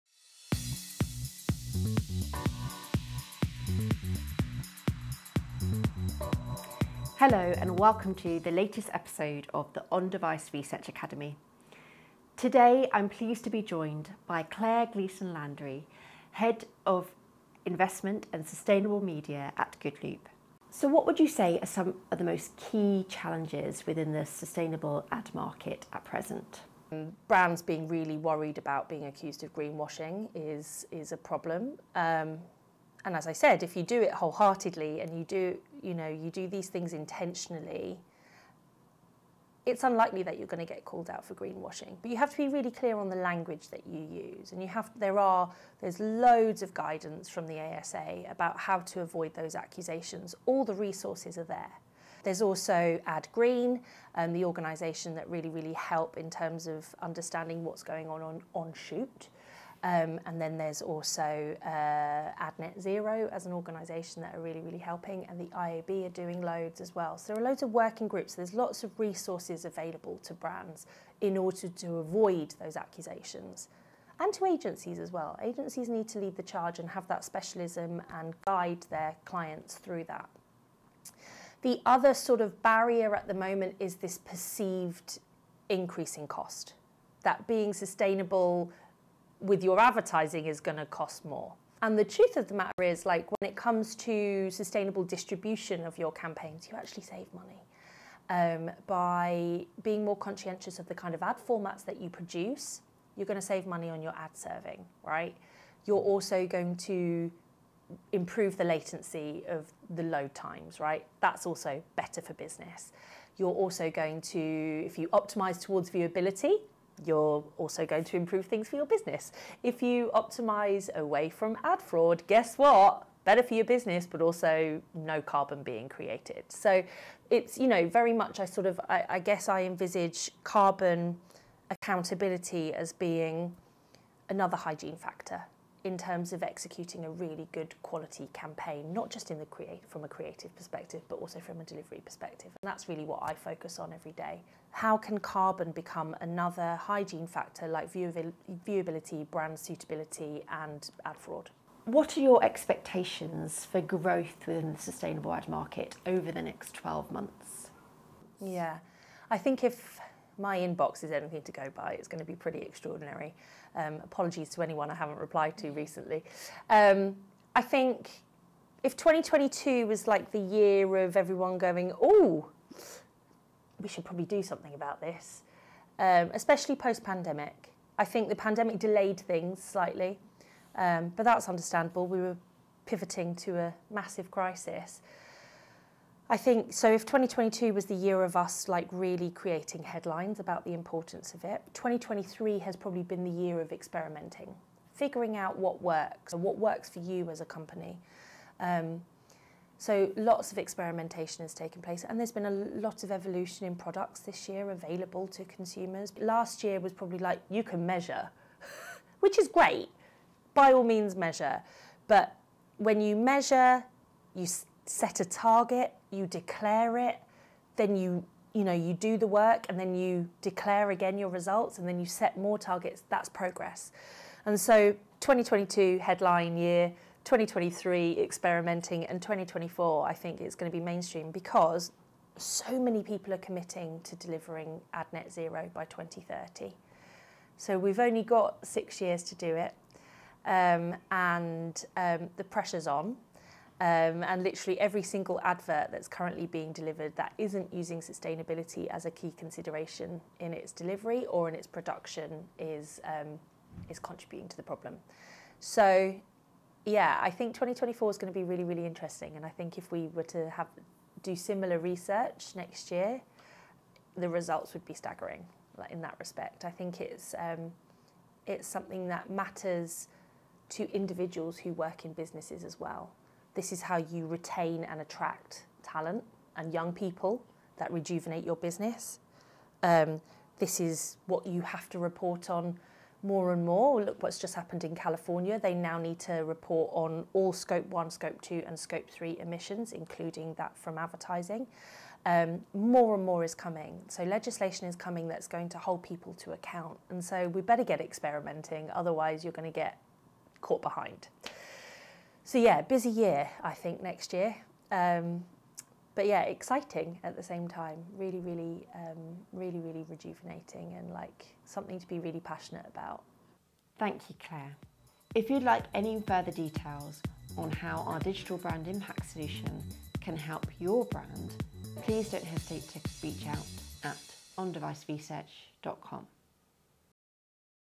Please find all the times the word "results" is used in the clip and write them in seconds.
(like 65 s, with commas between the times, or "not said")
221 s, 264 s.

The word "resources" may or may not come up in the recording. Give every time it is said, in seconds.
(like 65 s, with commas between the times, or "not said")
50 s, 68 s.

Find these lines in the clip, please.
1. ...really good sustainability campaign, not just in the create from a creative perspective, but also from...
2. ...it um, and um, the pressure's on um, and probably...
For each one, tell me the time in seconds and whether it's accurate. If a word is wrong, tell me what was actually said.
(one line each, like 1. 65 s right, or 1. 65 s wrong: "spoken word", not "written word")
1. 137 s wrong: "quality", not "sustainability"
2. 239 s wrong: "literally", not "probably".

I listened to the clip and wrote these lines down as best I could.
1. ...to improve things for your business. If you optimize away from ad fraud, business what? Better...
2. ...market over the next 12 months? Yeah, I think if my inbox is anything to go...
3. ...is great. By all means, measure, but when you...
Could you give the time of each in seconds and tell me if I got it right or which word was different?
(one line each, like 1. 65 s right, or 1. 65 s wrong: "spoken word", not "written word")
1. 118 s wrong: "guess", not "business"
2. 155 s right
3. 209 s right.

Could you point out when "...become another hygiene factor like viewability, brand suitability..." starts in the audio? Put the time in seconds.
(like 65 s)
145 s.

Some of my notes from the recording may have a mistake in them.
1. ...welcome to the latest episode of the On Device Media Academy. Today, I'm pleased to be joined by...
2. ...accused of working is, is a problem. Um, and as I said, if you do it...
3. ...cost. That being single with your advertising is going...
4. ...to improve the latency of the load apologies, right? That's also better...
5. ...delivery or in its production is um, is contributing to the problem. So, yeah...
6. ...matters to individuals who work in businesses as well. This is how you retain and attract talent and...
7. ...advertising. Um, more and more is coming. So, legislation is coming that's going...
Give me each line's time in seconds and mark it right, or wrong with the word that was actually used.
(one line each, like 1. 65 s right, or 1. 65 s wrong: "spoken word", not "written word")
1. 7 s wrong: "Research", not "Media"
2. 29 s wrong: "greenwashing", not "working"
3. 86 s wrong: "sustainable", not "single"
4. 106 s wrong: "times", not "apologies"
5. 250 s right
6. 269 s right
7. 290 s right.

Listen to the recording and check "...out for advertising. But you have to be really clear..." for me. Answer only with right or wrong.
wrong.